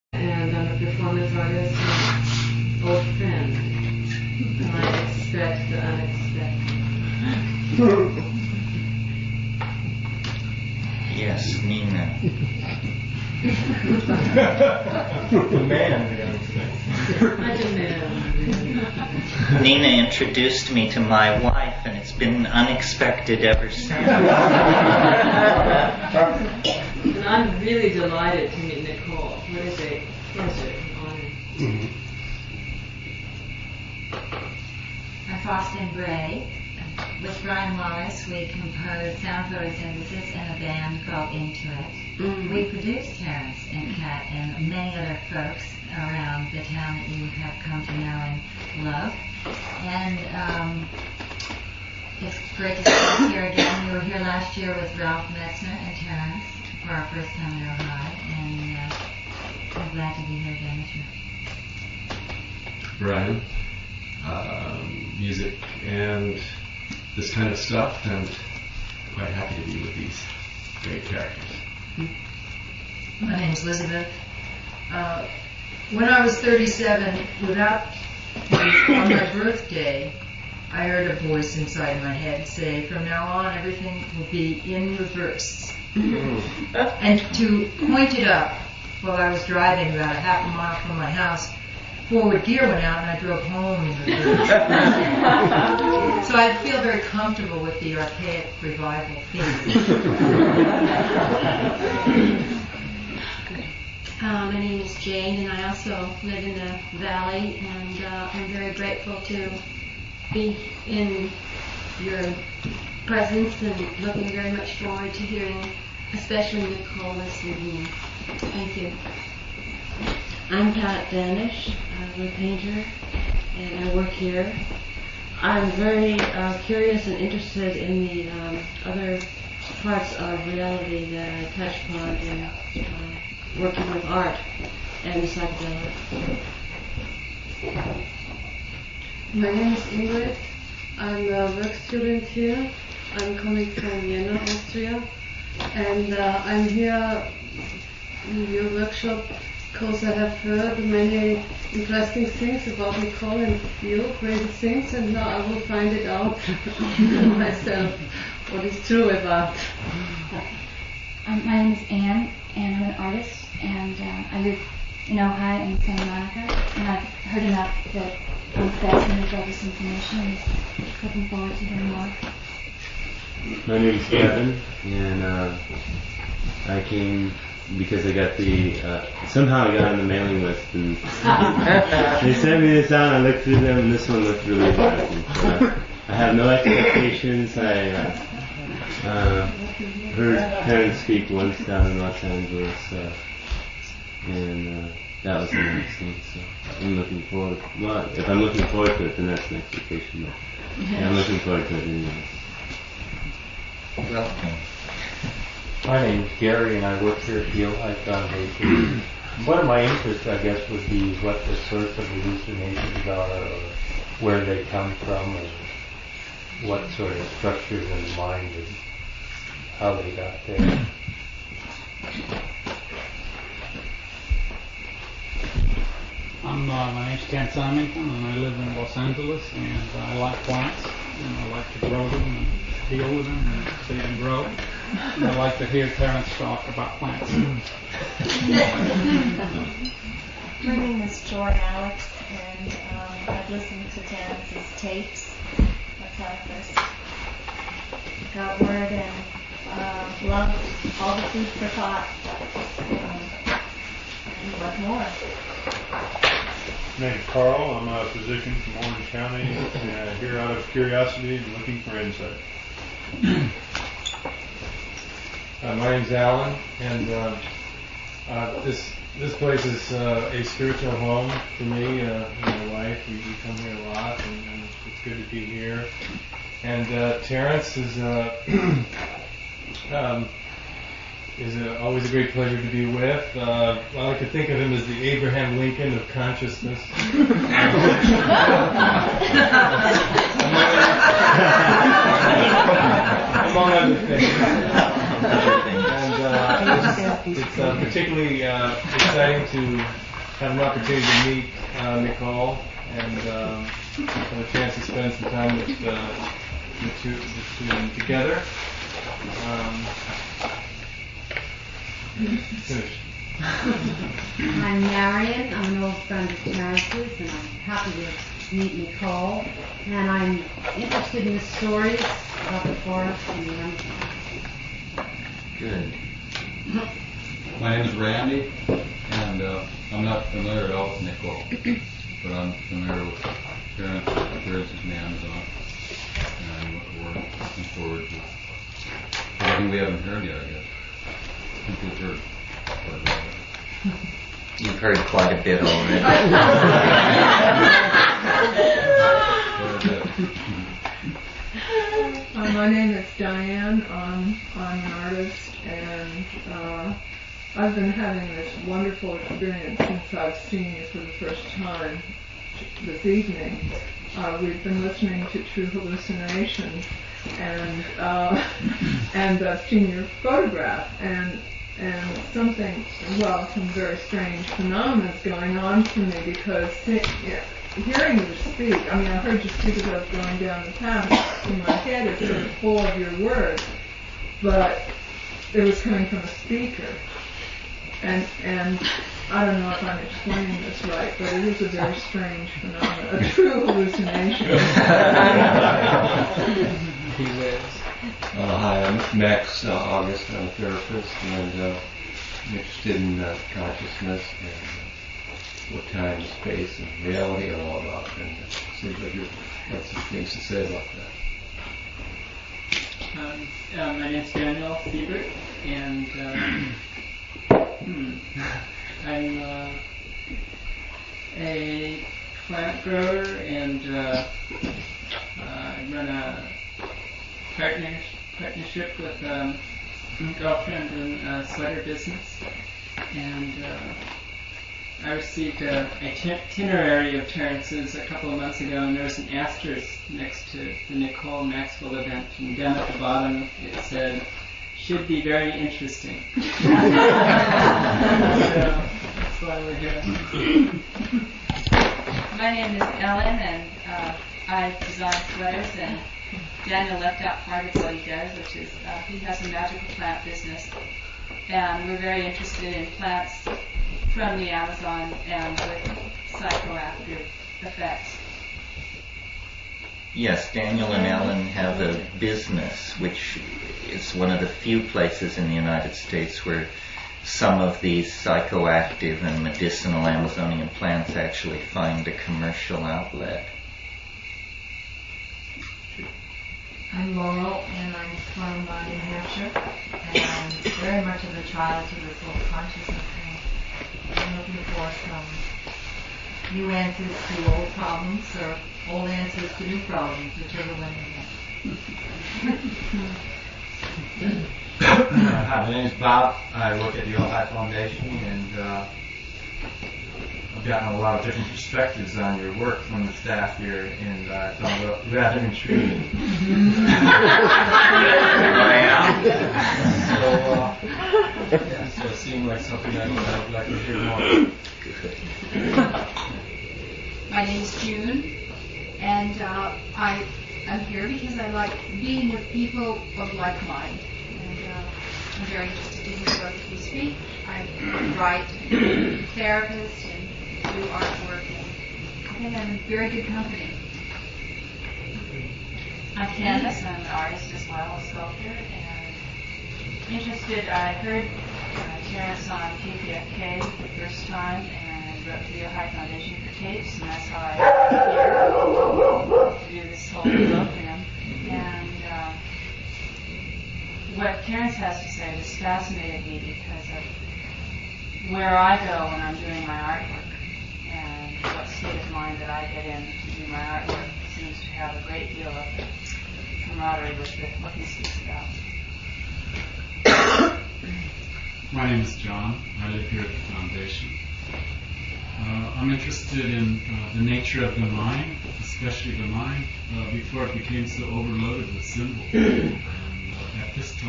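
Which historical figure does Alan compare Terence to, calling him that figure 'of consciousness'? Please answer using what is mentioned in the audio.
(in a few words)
Abraham Lincoln.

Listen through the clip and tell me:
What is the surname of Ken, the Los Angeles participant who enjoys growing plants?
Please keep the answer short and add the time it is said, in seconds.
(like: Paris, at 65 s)
Simington, at 227 s.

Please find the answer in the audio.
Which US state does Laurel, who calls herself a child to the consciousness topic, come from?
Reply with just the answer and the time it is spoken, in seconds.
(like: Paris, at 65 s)
New Hampshire, at 488 s.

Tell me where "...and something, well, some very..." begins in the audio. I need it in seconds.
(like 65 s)
371 s.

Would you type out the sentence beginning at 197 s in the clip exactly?
Well, if I'm looking forward to it, then that's an expectation.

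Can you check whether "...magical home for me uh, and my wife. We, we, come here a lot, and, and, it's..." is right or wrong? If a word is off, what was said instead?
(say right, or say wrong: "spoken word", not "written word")
wrong: "spiritual", not "magical".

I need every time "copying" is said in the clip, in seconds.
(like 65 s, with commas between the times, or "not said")
not said.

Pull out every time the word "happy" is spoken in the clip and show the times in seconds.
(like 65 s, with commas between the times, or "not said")
69 s, 317 s.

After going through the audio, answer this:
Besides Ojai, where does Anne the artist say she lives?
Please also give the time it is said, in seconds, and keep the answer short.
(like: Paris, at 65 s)
Santa Monica, at 165 s.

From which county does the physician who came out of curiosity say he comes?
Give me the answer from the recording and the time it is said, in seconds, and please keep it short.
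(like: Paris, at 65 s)
Orange County, at 258 s.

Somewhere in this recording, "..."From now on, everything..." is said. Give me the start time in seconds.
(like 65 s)
82 s.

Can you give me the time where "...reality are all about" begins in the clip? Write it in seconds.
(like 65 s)
407 s.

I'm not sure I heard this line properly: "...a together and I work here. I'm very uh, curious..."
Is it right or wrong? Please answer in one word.
wrong.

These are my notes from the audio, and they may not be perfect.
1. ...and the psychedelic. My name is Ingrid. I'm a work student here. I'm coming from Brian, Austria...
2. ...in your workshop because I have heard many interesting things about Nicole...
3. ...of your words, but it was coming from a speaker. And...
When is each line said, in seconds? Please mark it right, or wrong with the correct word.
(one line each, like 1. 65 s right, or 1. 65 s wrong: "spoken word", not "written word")
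1. 135 s wrong: "Vienna", not "Brian"
2. 148 s right
3. 382 s right.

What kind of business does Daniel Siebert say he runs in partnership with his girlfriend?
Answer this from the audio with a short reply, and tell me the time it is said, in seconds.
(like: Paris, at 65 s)
sweater business, at 431 s.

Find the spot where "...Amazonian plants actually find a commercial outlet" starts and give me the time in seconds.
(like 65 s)
480 s.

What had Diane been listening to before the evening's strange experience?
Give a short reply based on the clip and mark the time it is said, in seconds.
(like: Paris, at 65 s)
True Hallucinations, at 365 s.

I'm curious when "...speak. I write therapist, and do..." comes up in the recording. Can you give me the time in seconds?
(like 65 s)
536 s.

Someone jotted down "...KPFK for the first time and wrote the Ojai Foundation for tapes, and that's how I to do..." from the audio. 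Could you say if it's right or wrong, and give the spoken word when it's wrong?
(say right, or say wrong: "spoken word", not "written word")
right.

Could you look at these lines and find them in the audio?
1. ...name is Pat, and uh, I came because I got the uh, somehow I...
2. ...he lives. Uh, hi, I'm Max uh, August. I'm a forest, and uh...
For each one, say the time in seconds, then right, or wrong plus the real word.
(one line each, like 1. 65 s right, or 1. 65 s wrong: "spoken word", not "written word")
1. 173 s wrong: "Kevin", not "Pat"
2. 397 s wrong: "therapist", not "forest".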